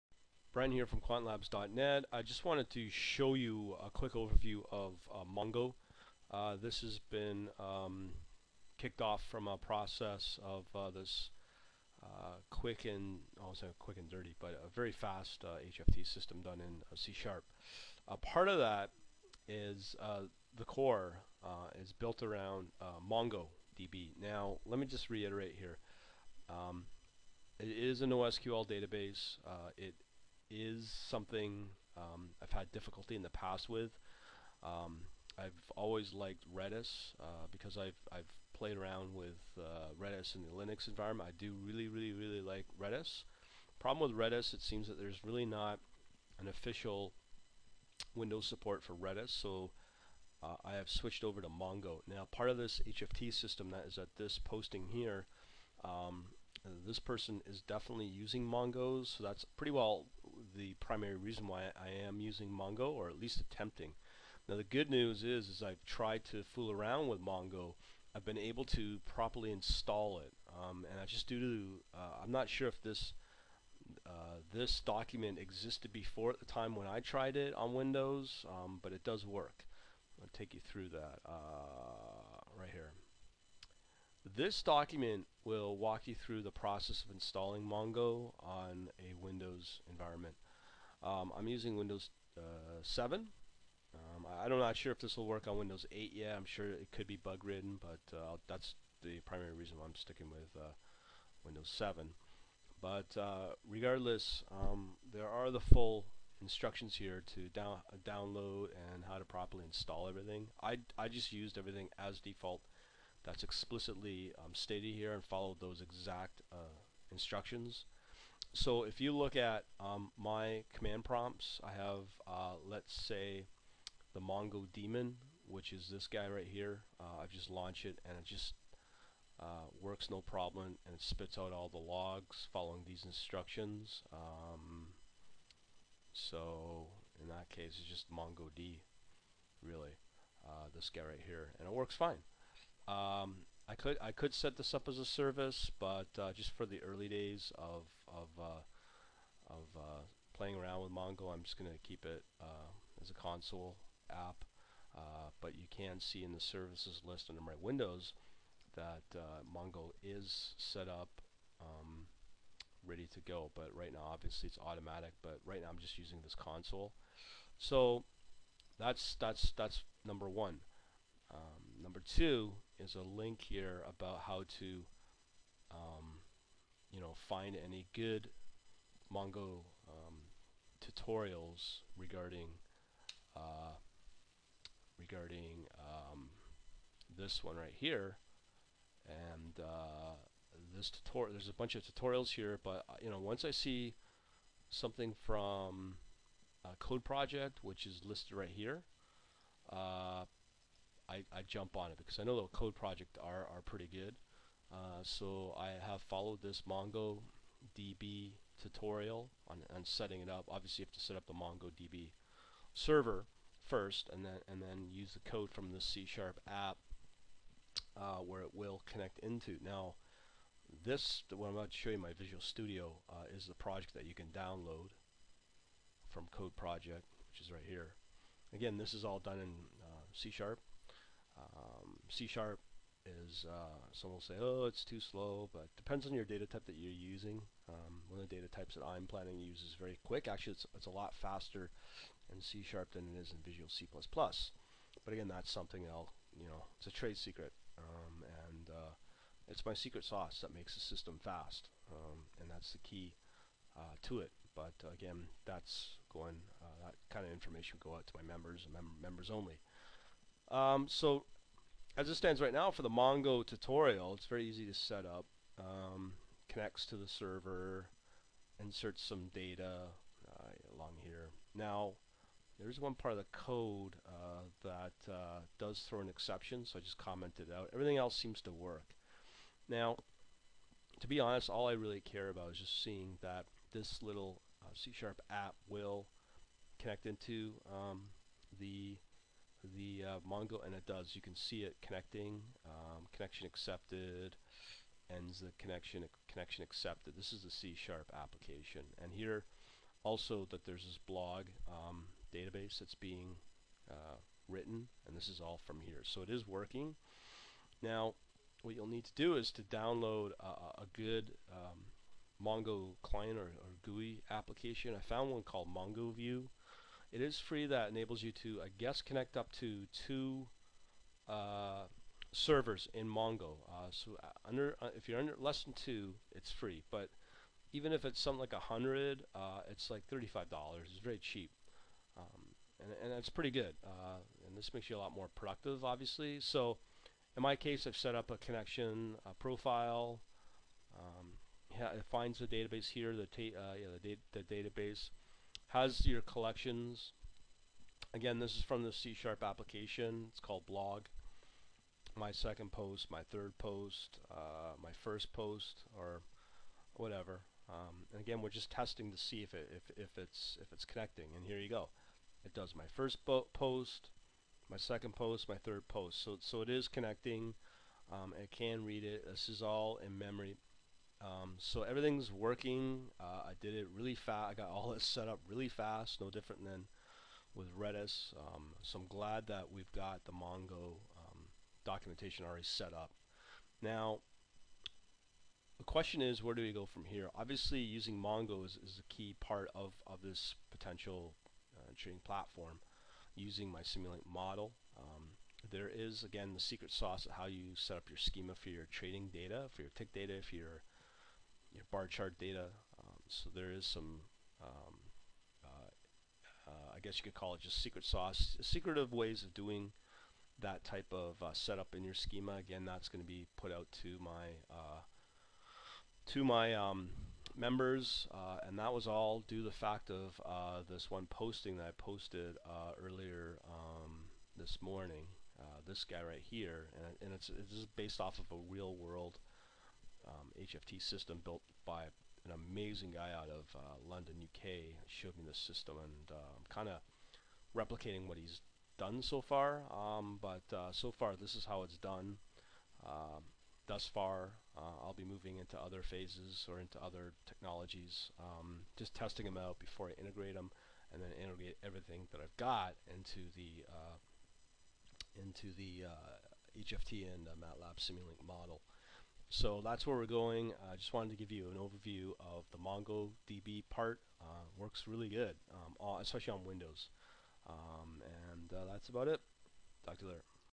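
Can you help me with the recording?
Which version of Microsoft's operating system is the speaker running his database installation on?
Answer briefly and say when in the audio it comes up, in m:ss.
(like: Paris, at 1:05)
Windows 7, at 1:31.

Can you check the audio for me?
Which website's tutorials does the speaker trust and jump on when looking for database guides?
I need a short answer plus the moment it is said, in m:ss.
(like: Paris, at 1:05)
CodeProject, at 3:16.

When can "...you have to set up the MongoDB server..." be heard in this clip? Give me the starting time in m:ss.
3:30.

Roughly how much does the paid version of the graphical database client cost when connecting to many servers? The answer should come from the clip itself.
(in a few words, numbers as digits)
35 dollars.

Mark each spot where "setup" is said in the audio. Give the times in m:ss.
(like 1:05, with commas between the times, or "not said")
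6:51.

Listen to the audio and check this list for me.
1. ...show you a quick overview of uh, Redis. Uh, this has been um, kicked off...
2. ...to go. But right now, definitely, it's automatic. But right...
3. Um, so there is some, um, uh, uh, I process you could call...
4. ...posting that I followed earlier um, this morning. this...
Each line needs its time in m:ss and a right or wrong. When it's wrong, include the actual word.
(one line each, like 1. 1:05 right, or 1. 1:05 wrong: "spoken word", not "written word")
1. 0:02 wrong: "Mongo", not "Redis"
2. 2:43 wrong: "obviously", not "definitely"
3. 6:42 wrong: "guess", not "process"
4. 7:01 wrong: "posted", not "followed".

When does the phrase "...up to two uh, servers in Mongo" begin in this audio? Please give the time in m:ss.
5:19.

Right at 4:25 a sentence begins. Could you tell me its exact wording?
Um, connects to the server, inserts some data uh, along here.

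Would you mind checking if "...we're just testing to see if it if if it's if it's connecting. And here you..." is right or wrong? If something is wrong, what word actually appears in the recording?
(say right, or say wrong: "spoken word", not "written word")
right.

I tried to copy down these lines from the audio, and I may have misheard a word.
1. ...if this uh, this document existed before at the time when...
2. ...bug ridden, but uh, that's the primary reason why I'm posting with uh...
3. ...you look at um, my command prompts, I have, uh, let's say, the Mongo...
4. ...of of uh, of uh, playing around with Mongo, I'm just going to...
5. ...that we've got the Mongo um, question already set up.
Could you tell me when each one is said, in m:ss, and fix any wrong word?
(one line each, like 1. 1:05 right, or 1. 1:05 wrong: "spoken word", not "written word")
1. 1:12 right
2. 1:37 wrong: "sticking", not "posting"
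3. 1:58 right
4. 2:27 right
5. 6:19 wrong: "documentation", not "question".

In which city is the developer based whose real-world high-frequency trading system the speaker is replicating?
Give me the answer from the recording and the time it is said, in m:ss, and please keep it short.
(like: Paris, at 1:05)
London, at 7:14.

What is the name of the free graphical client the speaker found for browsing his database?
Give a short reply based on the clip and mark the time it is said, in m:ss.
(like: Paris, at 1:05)
MongoVUE, at 5:15.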